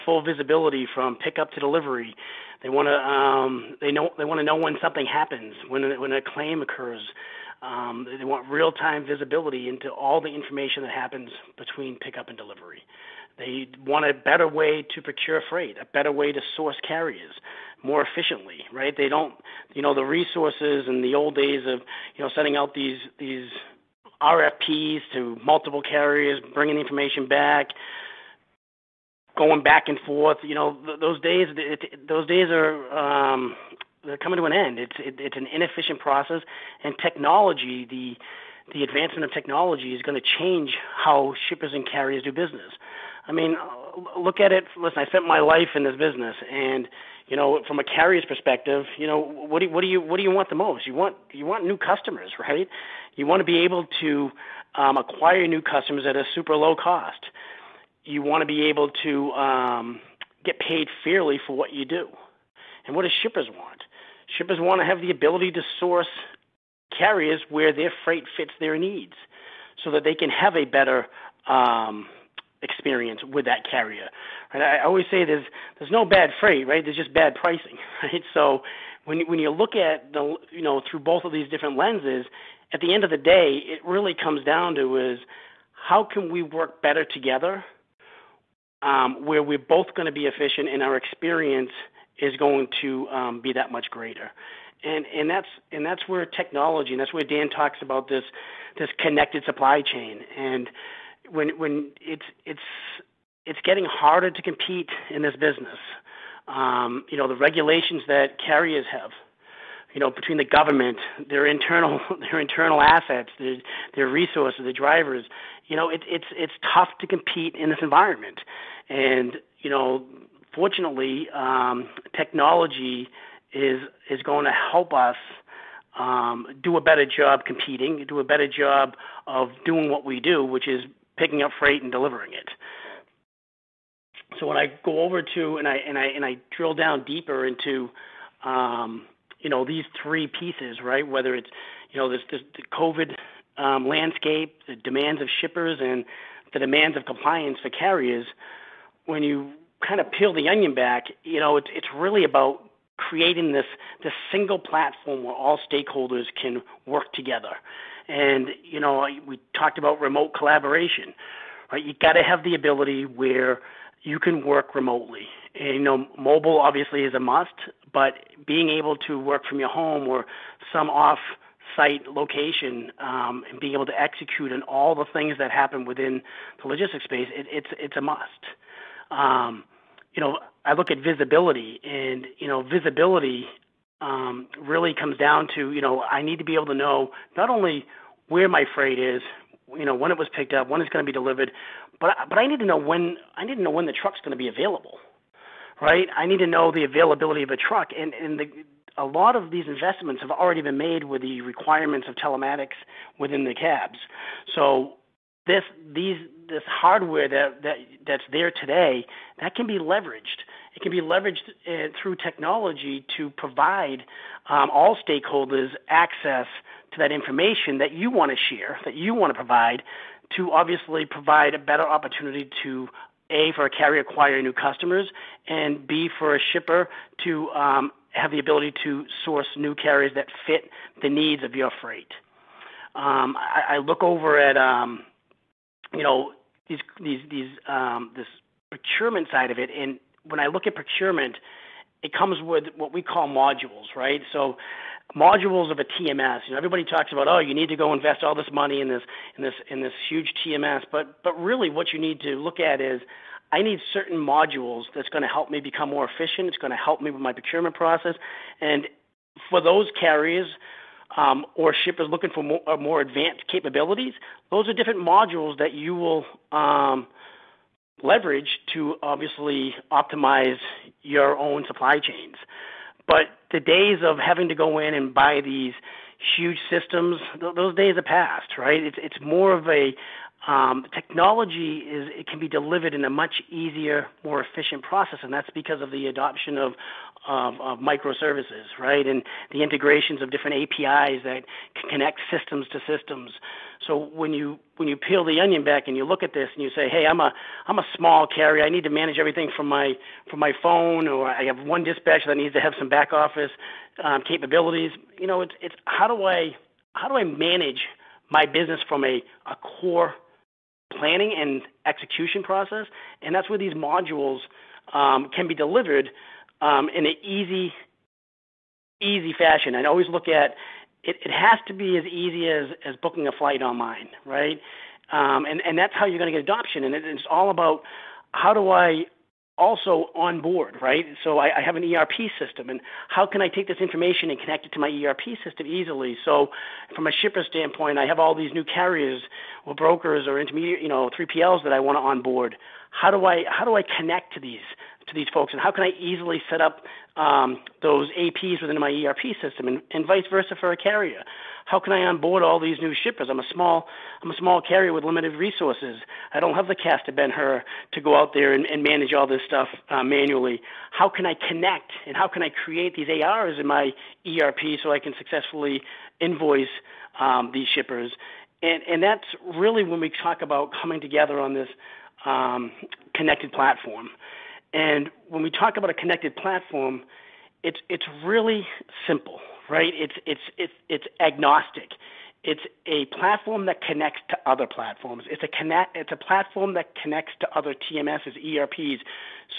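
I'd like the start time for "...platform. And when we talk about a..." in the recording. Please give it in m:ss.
6:13.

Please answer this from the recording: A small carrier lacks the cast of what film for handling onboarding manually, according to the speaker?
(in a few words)
Ben Hur.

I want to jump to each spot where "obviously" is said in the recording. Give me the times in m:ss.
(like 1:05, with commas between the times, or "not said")
2:46, 3:40, 4:29.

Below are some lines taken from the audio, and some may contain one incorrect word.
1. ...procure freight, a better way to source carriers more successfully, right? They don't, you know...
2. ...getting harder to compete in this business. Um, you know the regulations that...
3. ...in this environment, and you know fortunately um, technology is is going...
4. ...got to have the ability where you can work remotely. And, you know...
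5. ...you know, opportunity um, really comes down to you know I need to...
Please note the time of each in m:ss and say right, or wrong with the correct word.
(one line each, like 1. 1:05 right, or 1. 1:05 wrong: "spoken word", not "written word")
1. 0:15 wrong: "efficiently", not "successfully"
2. 1:43 right
3. 1:57 right
4. 2:42 right
5. 3:02 wrong: "visibility", not "opportunity".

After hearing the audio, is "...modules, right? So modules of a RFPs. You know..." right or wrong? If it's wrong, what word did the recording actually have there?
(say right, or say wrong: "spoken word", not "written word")
wrong: "TMS", not "RFPs".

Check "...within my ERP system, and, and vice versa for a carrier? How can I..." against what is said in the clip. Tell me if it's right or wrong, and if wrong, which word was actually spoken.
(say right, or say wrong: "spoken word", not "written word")
right.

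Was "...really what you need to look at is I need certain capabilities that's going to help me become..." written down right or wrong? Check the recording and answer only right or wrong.
wrong.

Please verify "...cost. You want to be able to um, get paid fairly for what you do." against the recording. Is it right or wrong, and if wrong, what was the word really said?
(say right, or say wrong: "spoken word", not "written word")
right.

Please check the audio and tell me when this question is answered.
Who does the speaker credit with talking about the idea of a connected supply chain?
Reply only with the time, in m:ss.
1:37.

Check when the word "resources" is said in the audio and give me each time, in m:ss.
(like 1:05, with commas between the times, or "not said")
0:20, 1:54, 5:55.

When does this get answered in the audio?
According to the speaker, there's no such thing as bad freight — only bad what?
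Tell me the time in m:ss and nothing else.
1:17.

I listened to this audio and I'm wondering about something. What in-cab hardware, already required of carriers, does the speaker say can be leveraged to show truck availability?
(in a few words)
Telematics.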